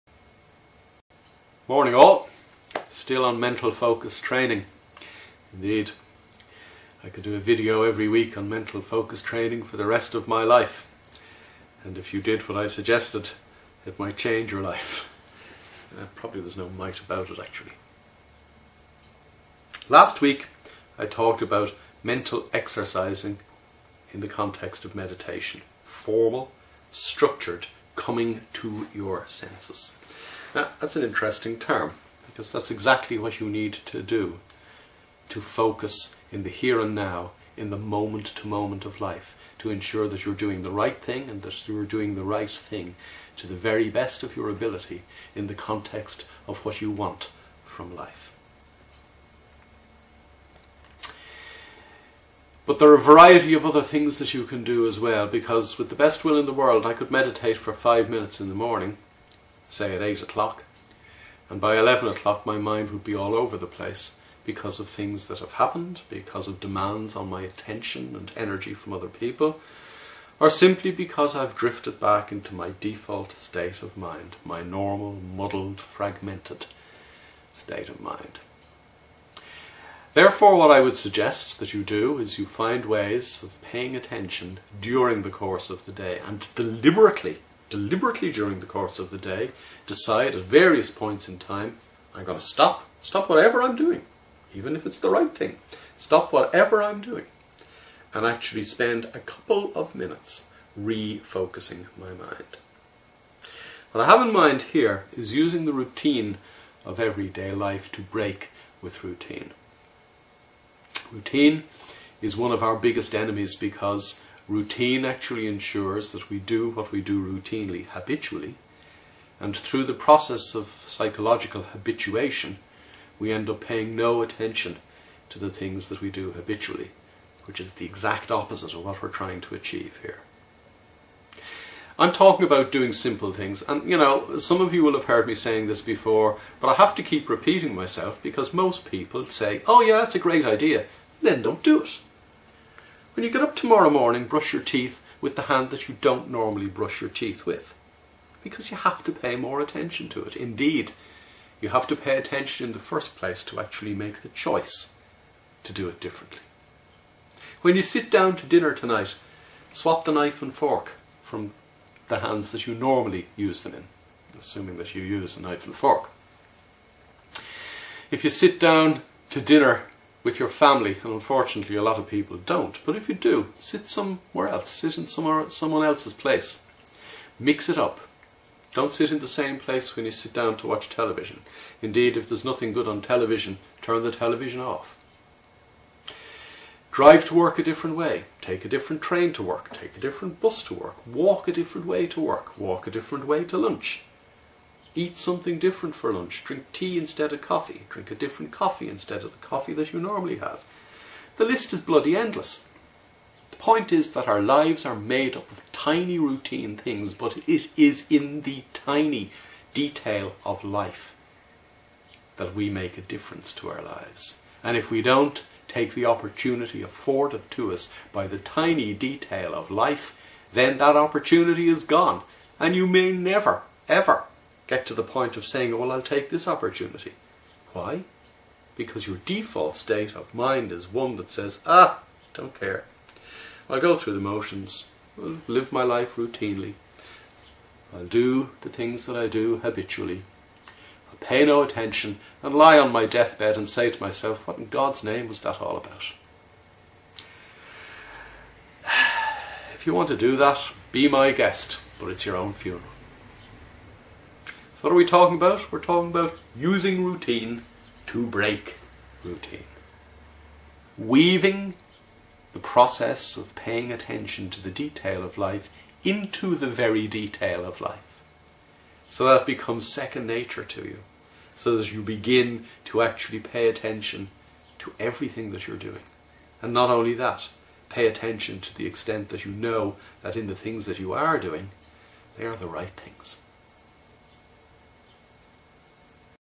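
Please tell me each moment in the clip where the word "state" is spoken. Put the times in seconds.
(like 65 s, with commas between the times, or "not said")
73 s, 77 s, 229 s.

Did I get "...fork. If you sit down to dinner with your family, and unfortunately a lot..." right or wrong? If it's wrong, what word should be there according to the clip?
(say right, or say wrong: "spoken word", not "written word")
right.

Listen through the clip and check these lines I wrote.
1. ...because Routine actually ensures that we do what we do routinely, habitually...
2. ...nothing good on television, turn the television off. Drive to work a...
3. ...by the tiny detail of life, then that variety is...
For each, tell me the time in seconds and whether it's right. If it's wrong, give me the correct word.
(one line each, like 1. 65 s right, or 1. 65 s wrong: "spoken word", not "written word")
1. 113 s right
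2. 182 s right
3. 218 s wrong: "opportunity", not "variety".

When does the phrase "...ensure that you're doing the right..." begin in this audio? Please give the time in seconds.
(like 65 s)
39 s.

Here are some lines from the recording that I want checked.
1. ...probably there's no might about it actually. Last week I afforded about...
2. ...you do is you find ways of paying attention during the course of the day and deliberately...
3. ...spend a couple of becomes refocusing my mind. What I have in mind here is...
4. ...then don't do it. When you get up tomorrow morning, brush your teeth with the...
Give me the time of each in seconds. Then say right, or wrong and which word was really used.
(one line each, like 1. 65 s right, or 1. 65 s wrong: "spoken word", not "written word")
1. 16 s wrong: "talked", not "afforded"
2. 81 s right
3. 98 s wrong: "minutes", not "becomes"
4. 141 s right.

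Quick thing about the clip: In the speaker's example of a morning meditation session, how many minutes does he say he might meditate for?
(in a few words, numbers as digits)
5.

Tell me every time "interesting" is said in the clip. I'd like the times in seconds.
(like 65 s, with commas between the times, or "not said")
31 s.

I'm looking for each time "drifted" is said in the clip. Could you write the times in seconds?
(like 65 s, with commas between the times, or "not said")
71 s.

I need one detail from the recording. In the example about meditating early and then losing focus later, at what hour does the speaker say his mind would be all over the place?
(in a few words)
11 o'clock.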